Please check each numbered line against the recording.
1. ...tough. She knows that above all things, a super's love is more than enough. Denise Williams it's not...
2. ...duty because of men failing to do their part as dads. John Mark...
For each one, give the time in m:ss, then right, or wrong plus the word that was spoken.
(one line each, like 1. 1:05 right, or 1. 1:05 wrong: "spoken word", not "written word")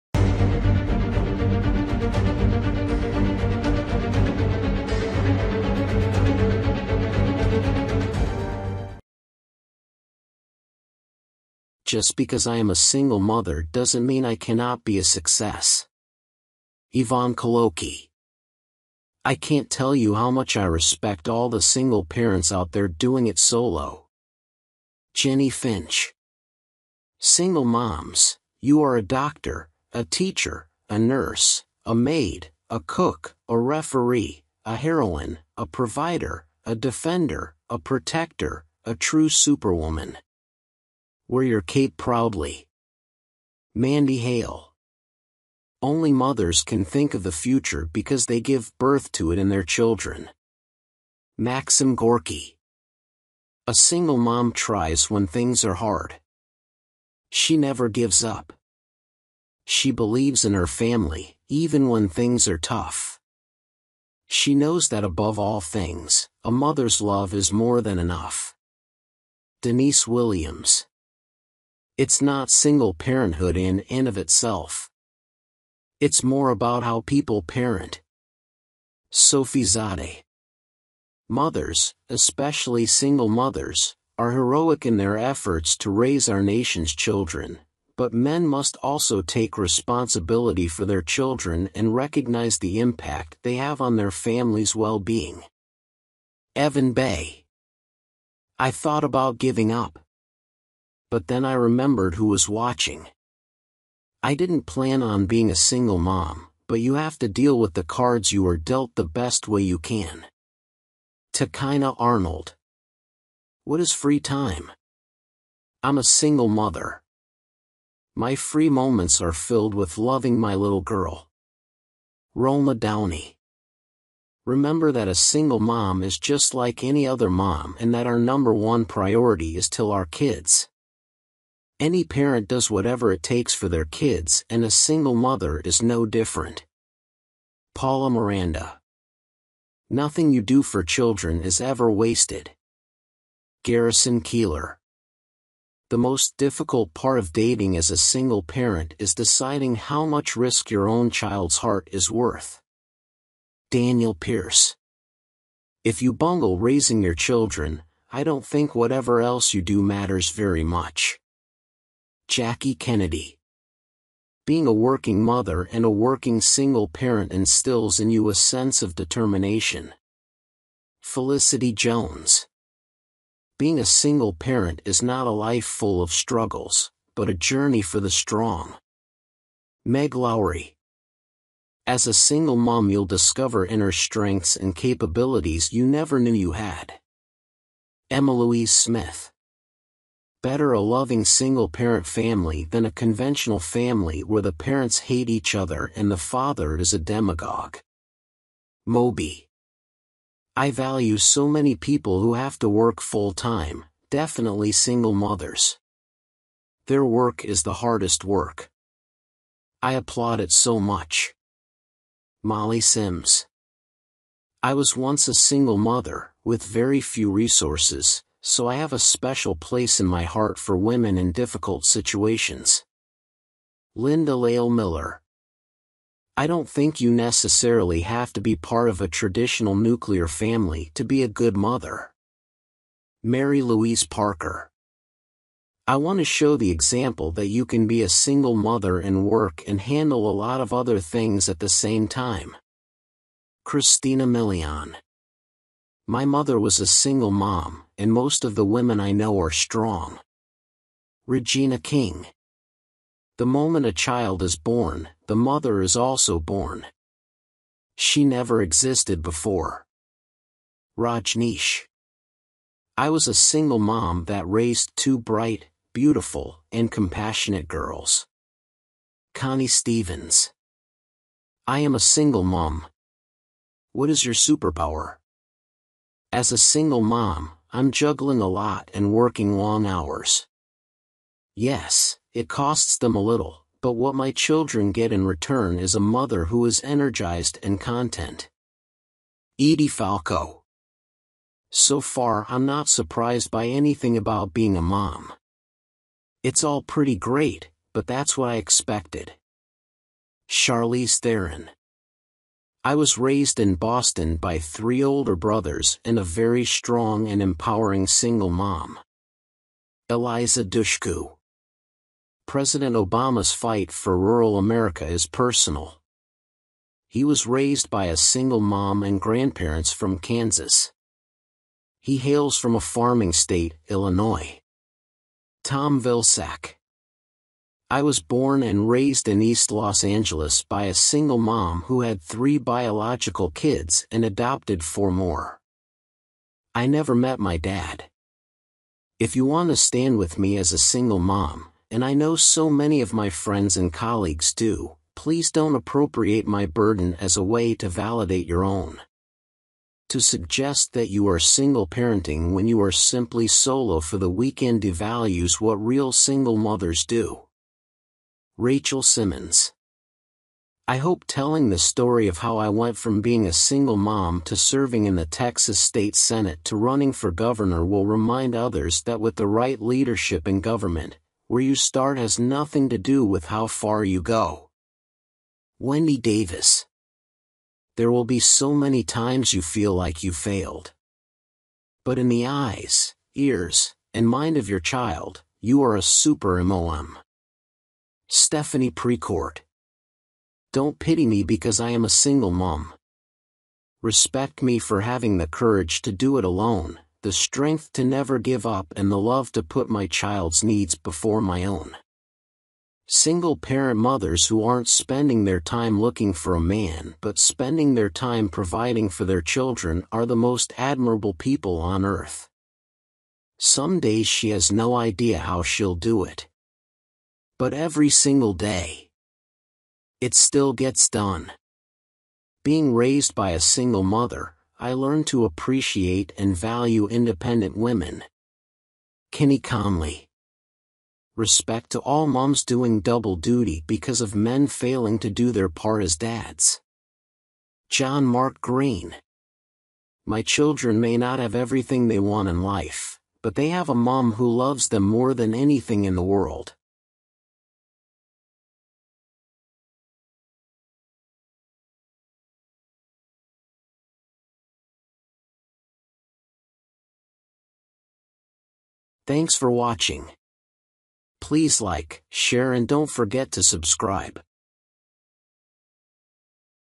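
1. 1:02 wrong: "mother", not "super"
2. 7:13 right.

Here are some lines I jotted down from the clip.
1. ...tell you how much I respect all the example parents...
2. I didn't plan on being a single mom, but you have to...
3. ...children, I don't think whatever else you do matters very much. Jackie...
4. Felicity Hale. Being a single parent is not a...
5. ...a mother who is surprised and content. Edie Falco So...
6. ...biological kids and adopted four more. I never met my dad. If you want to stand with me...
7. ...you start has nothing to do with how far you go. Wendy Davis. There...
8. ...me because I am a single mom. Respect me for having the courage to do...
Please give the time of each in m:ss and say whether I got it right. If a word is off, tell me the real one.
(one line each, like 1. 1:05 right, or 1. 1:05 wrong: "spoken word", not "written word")
1. 0:19 wrong: "single", not "example"
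2. 1:44 right
3. 2:37 right
4. 2:51 wrong: "Jones", not "Hale"
5. 4:45 wrong: "energized", not "surprised"
6. 5:32 right
7. 6:11 right
8. 6:31 right.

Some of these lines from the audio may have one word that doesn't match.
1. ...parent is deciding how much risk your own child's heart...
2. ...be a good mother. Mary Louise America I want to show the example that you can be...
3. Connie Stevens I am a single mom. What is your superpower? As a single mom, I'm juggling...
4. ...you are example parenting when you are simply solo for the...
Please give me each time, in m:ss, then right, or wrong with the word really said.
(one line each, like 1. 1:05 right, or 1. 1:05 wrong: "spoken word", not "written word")
1. 2:28 right
2. 3:51 wrong: "Parker", not "America"
3. 4:29 right
4. 5:51 wrong: "single", not "example".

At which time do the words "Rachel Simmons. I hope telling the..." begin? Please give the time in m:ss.
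5:58.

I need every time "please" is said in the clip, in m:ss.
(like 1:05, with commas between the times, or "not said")
5:45, 7:41.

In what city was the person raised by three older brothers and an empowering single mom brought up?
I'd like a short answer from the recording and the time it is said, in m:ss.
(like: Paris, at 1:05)
Boston, at 5:03.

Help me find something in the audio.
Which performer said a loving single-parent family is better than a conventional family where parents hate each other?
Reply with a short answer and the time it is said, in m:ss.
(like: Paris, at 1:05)
Moby, at 3:18.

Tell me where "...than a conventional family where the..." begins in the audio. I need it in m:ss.
3:12.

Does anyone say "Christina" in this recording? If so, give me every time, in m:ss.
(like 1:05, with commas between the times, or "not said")
4:03.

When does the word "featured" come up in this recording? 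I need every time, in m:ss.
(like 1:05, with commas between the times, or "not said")
not said.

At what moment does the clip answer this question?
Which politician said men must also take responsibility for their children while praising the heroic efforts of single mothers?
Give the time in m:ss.
1:36.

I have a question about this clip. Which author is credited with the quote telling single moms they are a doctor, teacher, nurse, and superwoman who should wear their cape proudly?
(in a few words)
Mandy Hale.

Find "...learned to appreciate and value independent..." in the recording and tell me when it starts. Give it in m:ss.
7:04.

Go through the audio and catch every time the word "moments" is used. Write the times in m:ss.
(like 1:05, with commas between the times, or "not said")
1:58, 4:13.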